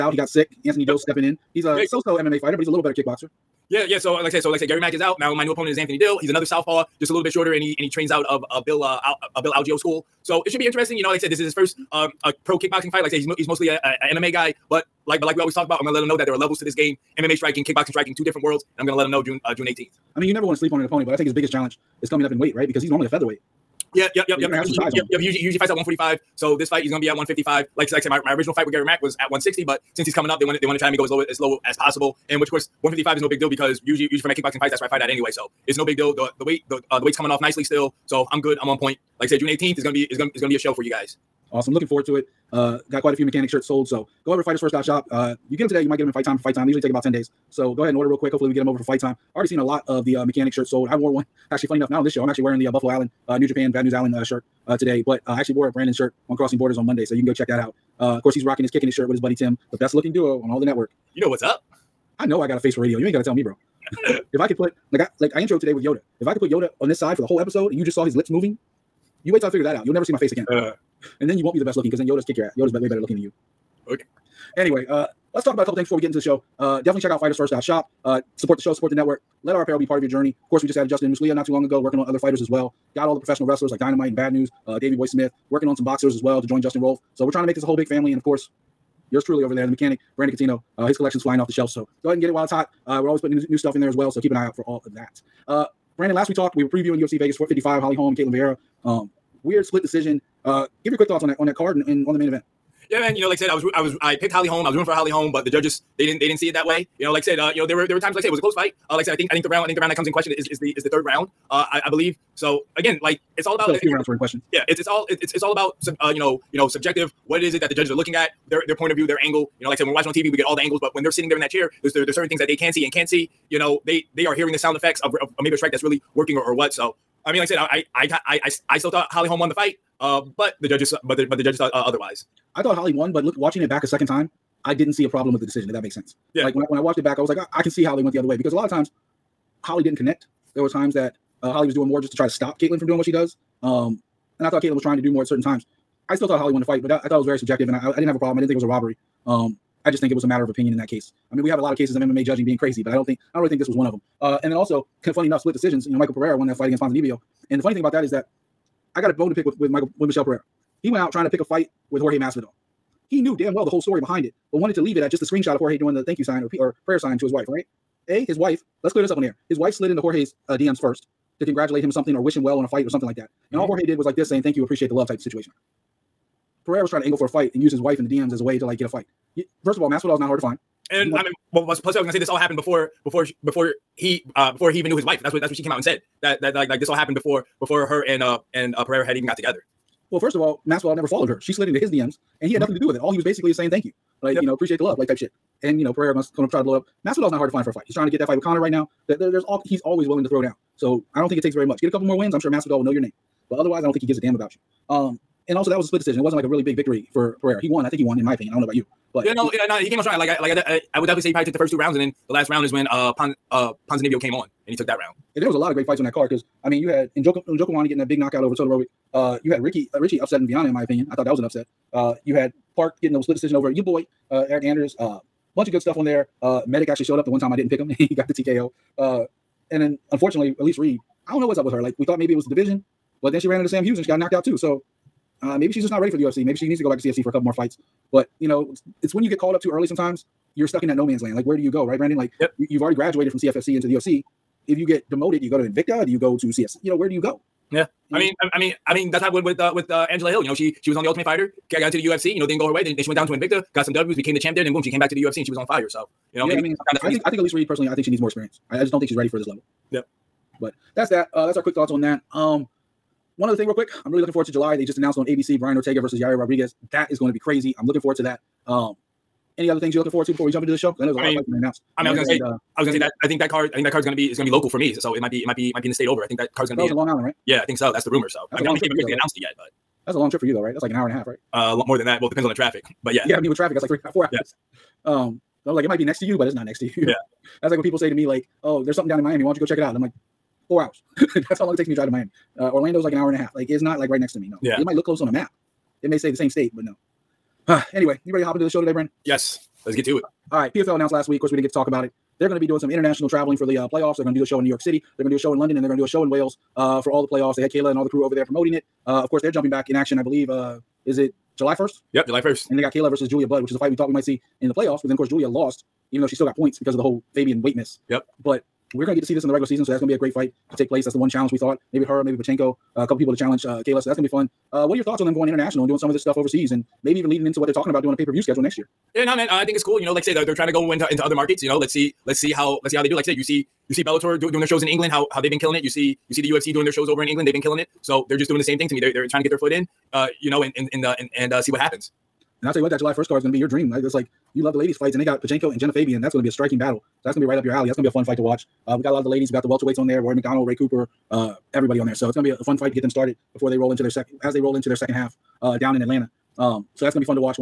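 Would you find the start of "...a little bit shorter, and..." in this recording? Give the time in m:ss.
0:07.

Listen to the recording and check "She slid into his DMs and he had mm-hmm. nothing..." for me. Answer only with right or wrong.
right.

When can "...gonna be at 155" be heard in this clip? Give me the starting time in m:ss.
0:26.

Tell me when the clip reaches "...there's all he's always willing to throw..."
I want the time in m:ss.
3:19.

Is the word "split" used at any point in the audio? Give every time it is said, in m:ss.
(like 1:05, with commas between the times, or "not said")
1:39, 2:35, 3:25, 3:43.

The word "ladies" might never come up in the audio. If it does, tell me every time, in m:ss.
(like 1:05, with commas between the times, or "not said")
5:44, 5:49.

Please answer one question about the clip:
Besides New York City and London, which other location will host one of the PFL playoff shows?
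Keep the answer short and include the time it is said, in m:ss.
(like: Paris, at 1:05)
Wales, at 5:06.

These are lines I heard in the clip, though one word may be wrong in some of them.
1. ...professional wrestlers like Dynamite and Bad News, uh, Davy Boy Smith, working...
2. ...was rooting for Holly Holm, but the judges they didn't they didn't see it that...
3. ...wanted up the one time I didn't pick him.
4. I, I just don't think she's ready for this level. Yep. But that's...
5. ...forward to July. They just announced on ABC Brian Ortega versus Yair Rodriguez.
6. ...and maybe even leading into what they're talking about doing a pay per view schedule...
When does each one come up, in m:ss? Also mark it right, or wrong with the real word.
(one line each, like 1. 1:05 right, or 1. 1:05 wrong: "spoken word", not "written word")
1. 1:23 right
2. 1:44 right
3. 3:47 wrong: "showed", not "wanted"
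4. 4:18 right
5. 4:24 right
6. 5:26 right.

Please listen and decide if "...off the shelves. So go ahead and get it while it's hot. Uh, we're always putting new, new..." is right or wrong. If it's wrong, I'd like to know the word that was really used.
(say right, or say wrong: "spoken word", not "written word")
right.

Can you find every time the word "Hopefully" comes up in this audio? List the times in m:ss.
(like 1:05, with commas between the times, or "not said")
0:48.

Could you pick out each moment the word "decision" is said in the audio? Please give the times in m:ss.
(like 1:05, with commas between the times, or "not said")
1:39, 2:15, 2:35, 3:25, 3:43.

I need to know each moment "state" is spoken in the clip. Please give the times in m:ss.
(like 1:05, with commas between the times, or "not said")
4:35, 4:56.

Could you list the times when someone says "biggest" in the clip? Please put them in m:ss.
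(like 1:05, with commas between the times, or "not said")
0:21.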